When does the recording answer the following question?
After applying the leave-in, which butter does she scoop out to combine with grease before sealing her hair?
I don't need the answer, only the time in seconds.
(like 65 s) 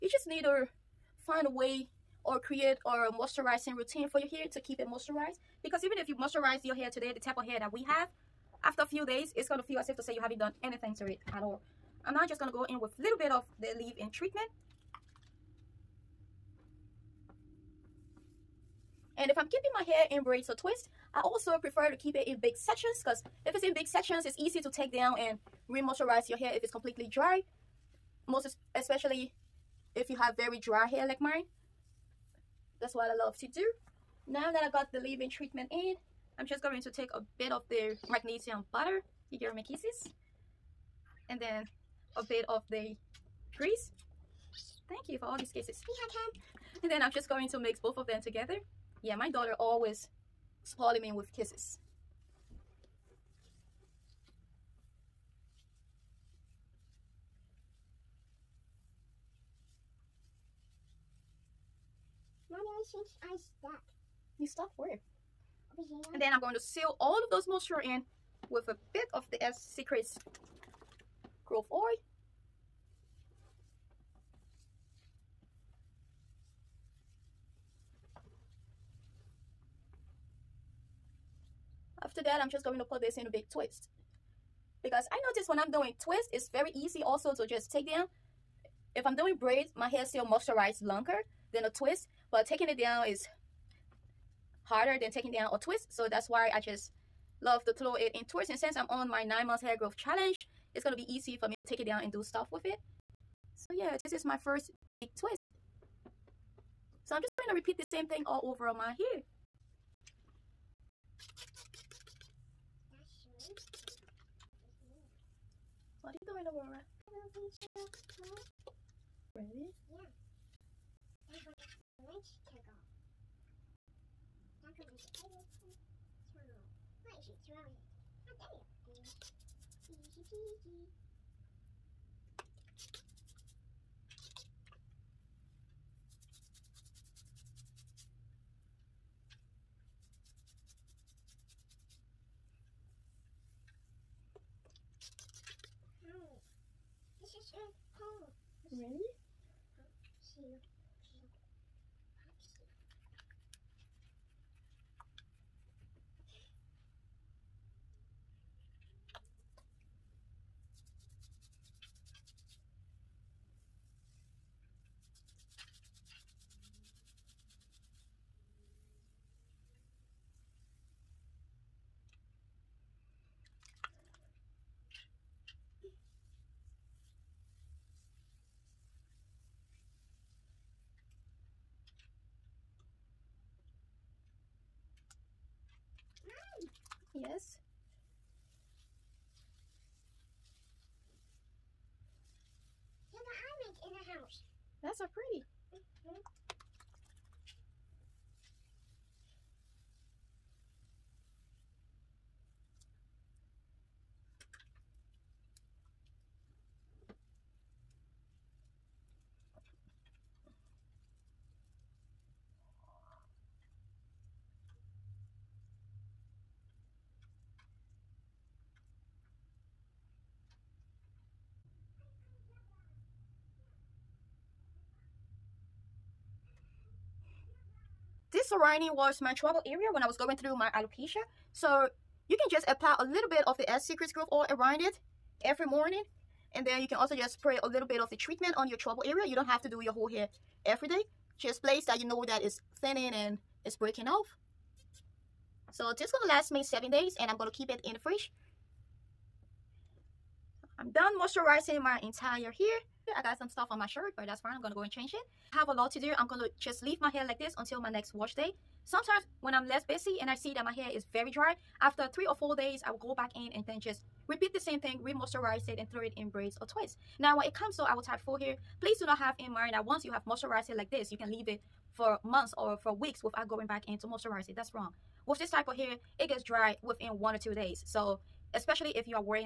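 38 s.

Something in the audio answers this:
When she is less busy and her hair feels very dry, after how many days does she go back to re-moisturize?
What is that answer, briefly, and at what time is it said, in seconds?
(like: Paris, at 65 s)
3 or 4 days, at 262 s.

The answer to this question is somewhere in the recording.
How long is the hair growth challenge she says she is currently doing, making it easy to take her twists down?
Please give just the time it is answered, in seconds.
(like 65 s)
99 s.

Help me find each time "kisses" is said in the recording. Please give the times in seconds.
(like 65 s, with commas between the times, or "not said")
39 s, 45 s, 51 s.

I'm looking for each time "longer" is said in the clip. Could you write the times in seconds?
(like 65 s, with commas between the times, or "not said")
90 s.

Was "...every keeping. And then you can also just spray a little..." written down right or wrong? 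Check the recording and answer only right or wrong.
wrong.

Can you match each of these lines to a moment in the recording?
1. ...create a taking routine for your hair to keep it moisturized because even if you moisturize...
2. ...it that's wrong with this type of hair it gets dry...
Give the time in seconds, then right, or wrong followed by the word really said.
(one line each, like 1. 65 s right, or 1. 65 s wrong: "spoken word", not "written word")
1. 2 s wrong: "moisturizing", not "taking"
2. 274 s right.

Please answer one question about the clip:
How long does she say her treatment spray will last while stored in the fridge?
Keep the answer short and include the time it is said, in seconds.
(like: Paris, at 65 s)
7 days, at 246 s.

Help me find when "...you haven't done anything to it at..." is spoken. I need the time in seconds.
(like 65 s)
10 s.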